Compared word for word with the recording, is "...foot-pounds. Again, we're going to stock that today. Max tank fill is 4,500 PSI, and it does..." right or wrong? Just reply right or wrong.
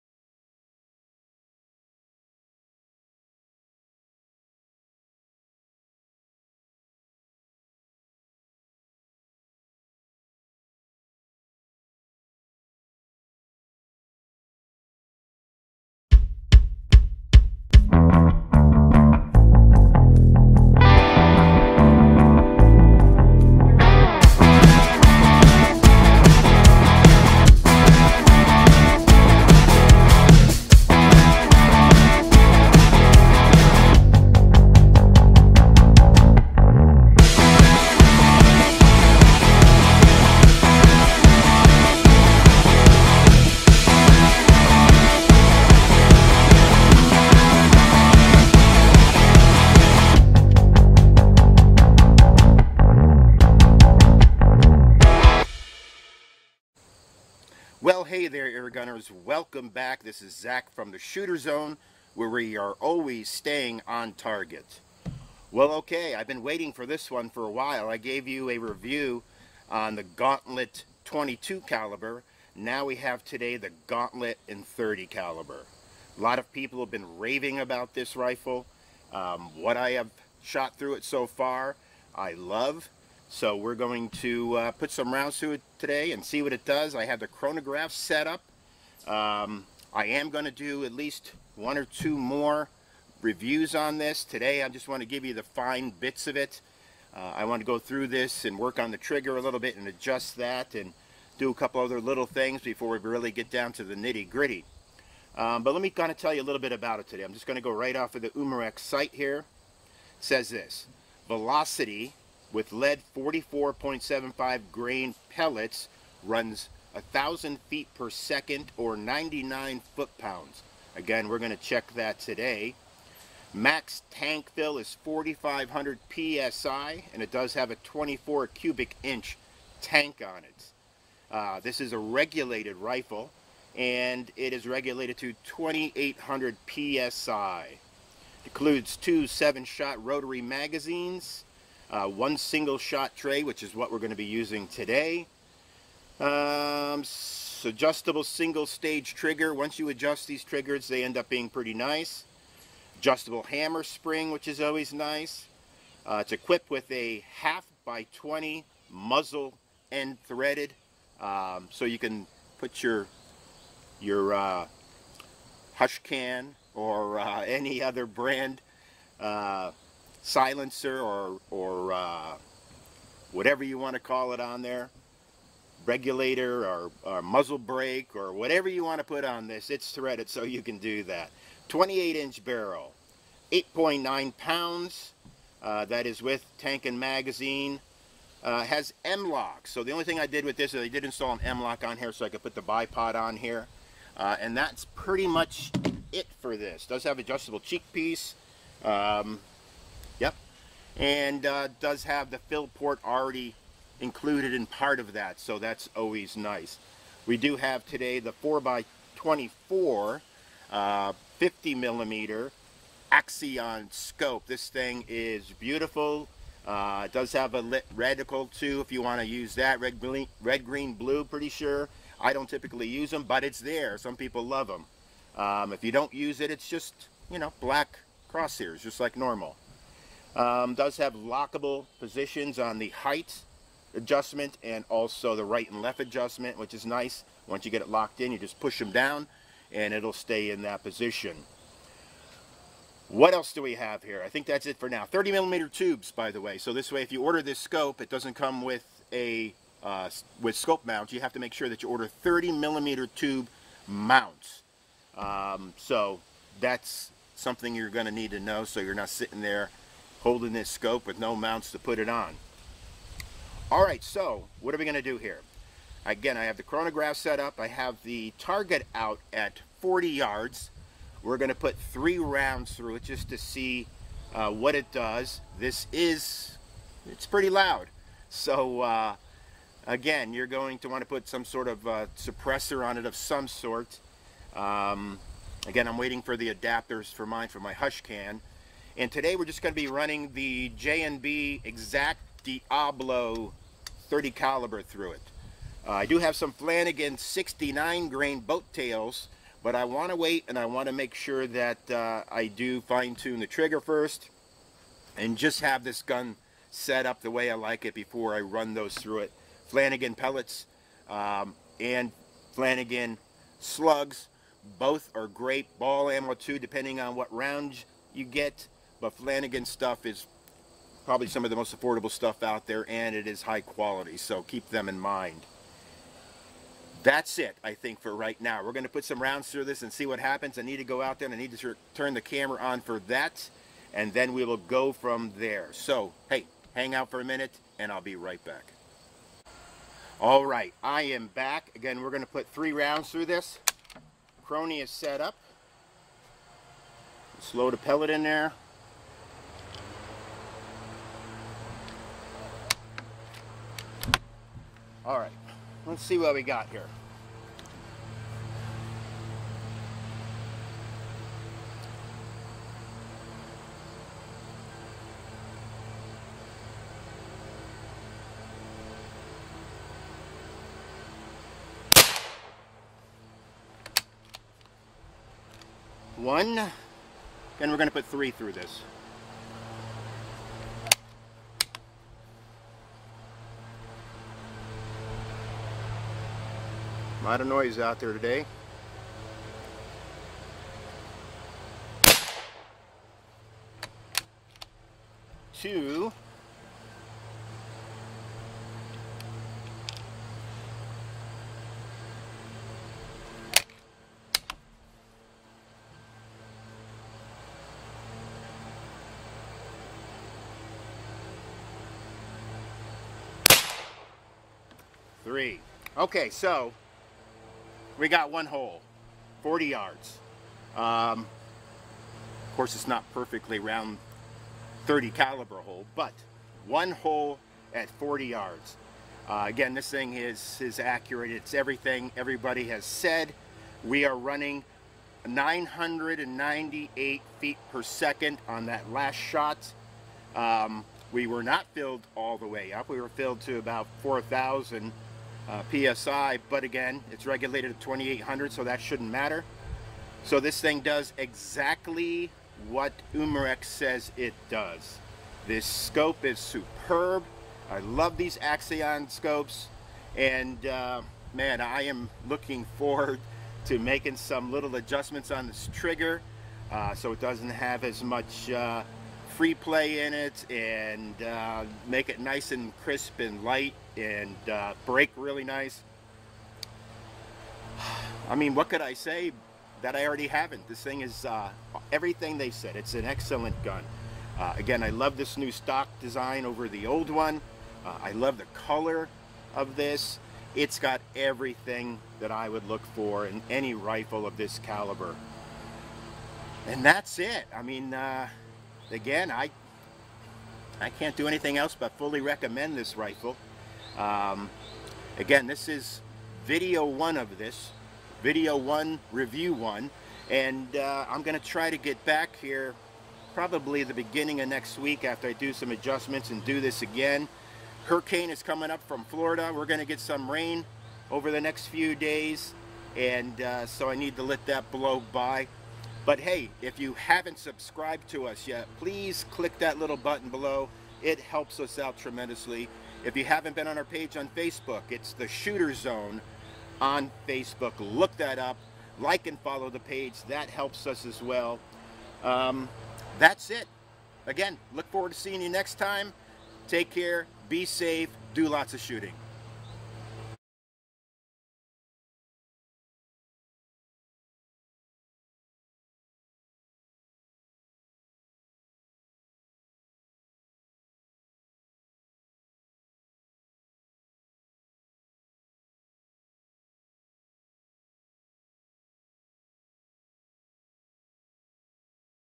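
wrong.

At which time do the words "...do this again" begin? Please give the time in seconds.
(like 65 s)
516 s.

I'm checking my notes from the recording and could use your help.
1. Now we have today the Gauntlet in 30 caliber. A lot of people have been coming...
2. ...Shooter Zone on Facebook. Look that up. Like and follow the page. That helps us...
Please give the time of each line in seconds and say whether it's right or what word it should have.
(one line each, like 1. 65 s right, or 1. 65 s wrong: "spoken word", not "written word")
1. 72 s wrong: "raving", not "coming"
2. 535 s right.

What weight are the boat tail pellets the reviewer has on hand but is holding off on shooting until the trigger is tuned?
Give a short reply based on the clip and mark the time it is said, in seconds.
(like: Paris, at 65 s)
69 grain, at 297 s.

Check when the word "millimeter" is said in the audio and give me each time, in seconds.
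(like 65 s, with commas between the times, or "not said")
211 s, 245 s, 252 s.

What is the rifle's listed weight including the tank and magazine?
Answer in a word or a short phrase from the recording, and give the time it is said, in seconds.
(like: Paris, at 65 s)
8.9 pounds, at 183 s.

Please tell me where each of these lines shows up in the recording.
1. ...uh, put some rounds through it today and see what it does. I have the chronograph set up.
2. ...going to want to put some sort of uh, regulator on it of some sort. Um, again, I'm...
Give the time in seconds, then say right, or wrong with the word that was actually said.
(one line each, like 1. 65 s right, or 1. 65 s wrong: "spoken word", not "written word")
1. 84 s right
2. 280 s wrong: "suppressor", not "regulator".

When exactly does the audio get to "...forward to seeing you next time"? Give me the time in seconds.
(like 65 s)
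544 s.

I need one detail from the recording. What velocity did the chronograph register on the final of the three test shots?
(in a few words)
998 feet per second.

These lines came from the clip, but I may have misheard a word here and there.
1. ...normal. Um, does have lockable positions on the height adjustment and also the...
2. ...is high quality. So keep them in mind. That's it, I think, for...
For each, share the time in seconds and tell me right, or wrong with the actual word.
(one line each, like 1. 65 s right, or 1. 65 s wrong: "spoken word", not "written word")
1. 229 s right
2. 323 s right.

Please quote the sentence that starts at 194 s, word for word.
Uh, and that's pretty much it for this.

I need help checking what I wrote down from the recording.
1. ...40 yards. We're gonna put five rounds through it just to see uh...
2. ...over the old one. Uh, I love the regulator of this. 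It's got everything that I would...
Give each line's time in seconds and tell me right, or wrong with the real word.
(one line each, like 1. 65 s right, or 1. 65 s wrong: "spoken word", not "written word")
1. 269 s wrong: "three", not "five"
2. 486 s wrong: "color", not "regulator".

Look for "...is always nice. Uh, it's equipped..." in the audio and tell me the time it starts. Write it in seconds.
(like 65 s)
154 s.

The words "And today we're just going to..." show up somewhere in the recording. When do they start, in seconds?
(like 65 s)
288 s.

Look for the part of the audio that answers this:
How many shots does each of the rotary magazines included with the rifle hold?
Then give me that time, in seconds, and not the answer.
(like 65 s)
139 s.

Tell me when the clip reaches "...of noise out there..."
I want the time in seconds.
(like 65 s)
387 s.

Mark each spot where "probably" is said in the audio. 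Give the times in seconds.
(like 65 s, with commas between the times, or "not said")
321 s, 513 s.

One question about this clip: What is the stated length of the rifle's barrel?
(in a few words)
28 inches.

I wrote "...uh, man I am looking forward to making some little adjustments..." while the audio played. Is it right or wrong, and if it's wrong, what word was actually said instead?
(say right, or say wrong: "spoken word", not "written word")
right.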